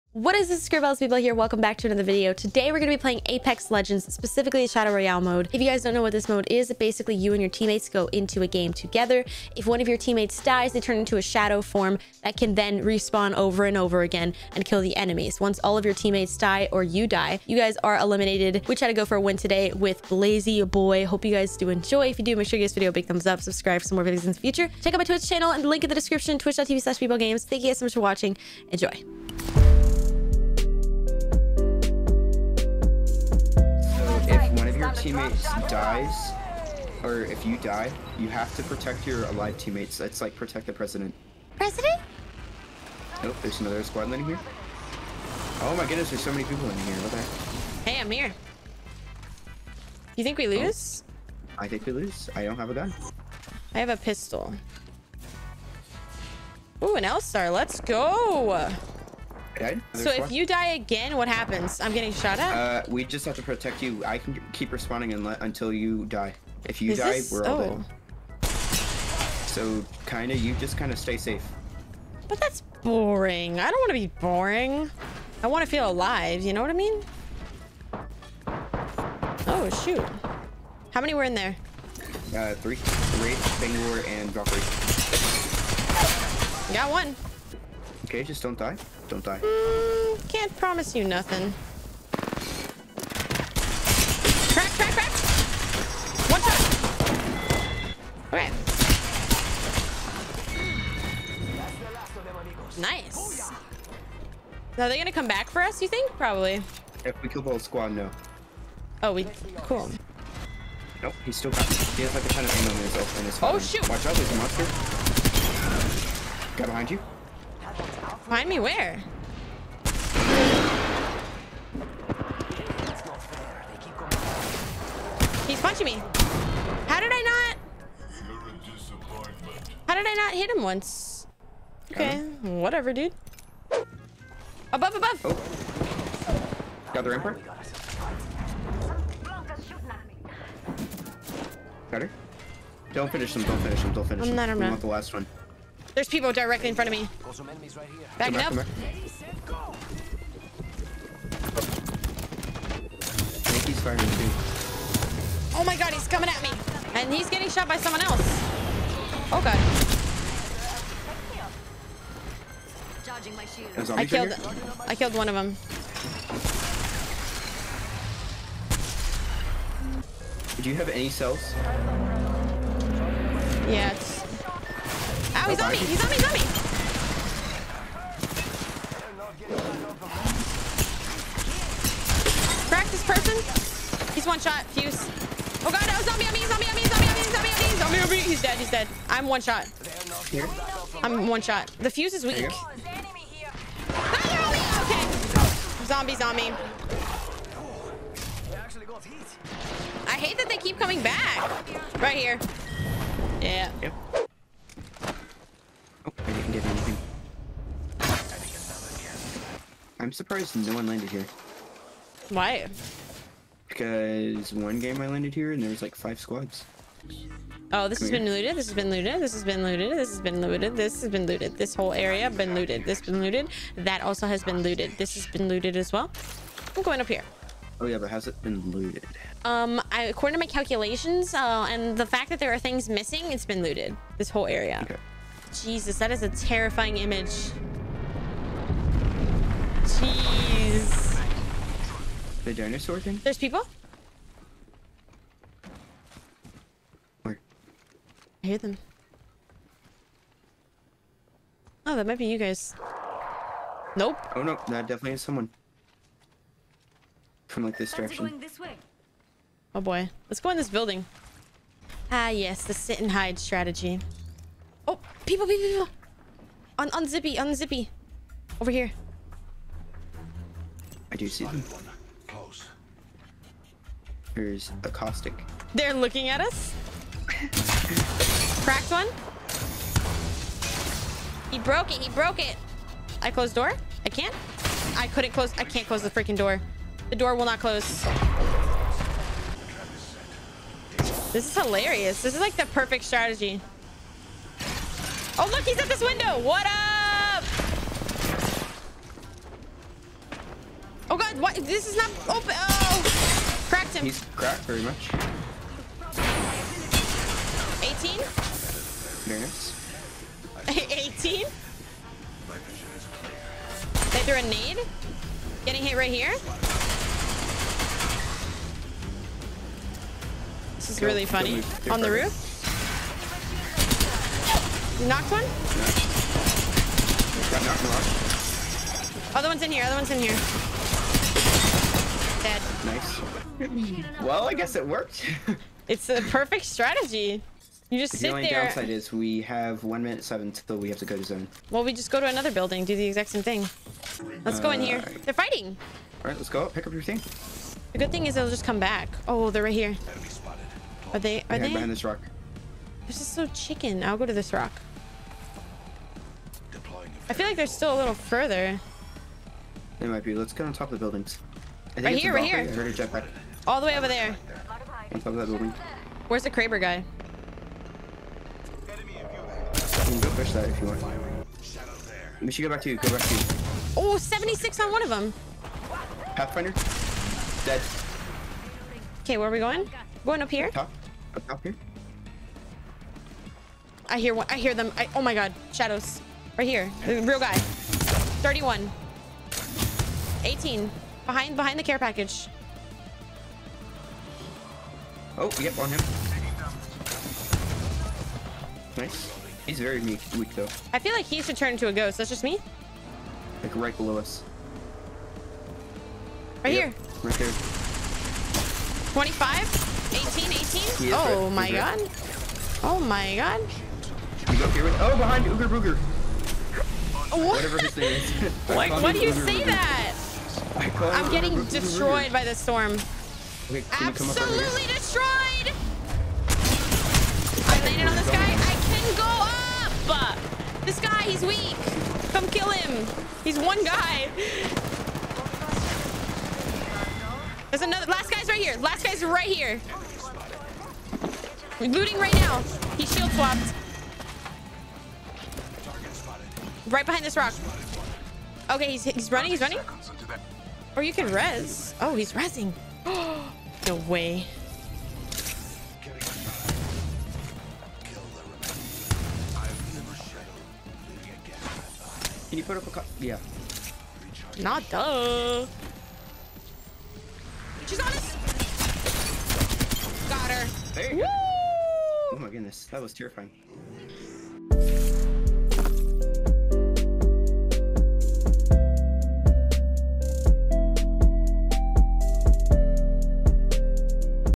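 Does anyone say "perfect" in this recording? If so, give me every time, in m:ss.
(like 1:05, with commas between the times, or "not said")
4:52, 5:36.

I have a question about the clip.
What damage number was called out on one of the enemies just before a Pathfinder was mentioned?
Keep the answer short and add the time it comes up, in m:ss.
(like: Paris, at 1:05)
76, at 6:14.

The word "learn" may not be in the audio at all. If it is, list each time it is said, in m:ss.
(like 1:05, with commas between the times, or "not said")
not said.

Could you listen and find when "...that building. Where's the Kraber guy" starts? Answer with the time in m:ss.
6:05.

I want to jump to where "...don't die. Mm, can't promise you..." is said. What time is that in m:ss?
1:29.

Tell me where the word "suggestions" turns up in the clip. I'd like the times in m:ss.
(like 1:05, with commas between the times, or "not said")
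not said.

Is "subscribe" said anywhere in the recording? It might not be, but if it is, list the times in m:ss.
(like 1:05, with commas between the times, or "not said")
0:23.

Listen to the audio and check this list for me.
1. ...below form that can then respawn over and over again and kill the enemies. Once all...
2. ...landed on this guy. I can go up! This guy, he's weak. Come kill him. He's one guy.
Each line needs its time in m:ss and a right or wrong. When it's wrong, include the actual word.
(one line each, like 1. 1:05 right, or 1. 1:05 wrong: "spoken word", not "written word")
1. 0:11 wrong: "shadow", not "below"
2. 7:07 right.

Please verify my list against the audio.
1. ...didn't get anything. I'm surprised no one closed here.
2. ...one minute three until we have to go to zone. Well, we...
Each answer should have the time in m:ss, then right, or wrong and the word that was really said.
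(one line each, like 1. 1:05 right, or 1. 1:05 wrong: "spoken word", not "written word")
1. 3:26 wrong: "landed", not "closed"
2. 5:39 wrong: "seven", not "three".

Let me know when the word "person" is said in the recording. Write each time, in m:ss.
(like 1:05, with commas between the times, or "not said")
3:03.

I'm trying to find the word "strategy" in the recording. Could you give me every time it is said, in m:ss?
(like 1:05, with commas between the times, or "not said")
4:23, 4:53, 5:36.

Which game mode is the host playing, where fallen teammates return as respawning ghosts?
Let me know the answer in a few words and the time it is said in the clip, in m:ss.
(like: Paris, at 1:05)
Shadow Royale, at 0:04.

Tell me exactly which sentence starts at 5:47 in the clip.
The good thing is they'll just come back.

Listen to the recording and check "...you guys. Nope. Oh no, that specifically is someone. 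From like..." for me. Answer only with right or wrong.
wrong.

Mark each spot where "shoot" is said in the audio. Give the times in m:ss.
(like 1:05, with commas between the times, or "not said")
1:19, 1:53.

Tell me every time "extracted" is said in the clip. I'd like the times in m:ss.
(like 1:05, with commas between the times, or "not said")
not said.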